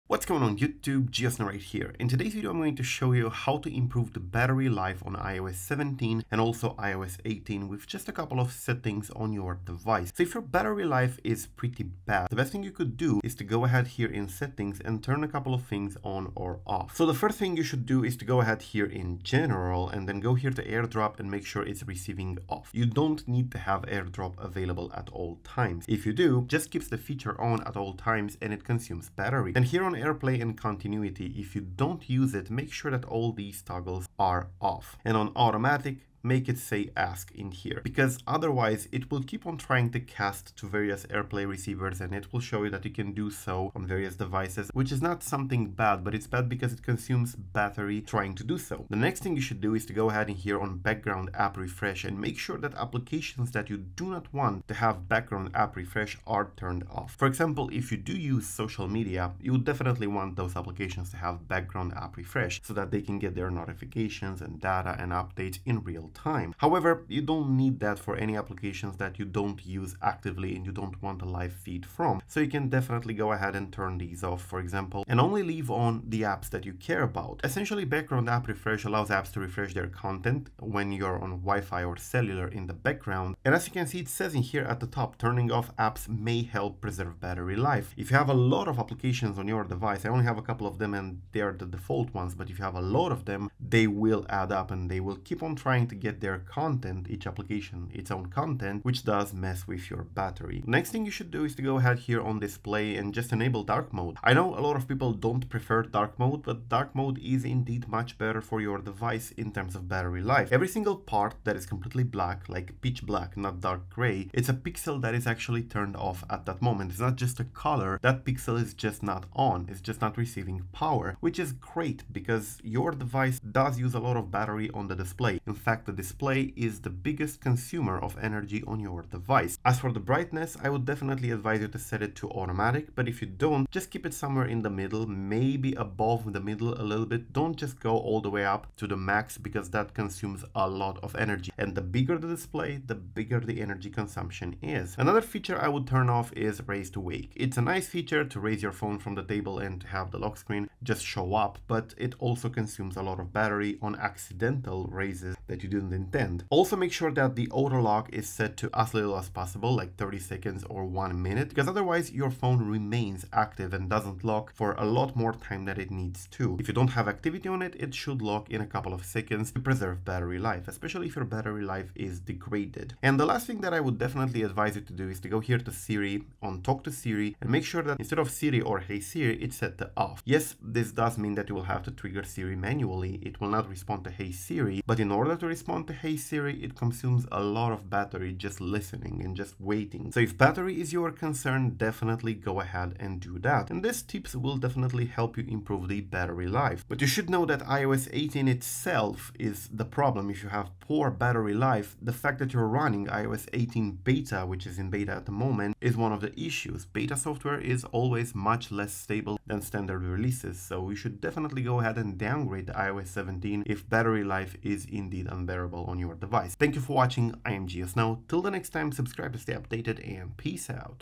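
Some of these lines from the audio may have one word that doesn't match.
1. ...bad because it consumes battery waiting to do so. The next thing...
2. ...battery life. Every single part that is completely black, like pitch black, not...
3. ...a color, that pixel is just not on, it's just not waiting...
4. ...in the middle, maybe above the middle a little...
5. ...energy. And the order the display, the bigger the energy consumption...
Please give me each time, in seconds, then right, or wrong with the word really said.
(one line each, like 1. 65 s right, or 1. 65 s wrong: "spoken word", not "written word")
1. 46 s wrong: "trying", not "waiting"
2. 109 s right
3. 117 s wrong: "receiving", not "waiting"
4. 134 s right
5. 141 s wrong: "bigger", not "order".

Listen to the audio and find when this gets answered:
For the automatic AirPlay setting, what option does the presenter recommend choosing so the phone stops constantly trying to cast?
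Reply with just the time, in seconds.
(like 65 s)
36 s.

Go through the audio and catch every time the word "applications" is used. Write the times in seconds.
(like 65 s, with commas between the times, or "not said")
52 s, 60 s, 68 s, 88 s, 97 s.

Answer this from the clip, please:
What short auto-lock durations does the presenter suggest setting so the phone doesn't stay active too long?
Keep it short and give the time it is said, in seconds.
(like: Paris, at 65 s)
30 seconds or one minute, at 159 s.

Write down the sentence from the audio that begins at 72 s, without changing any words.
So you can definitely go ahead and turn these off, for example, and only leave on the apps that you care about.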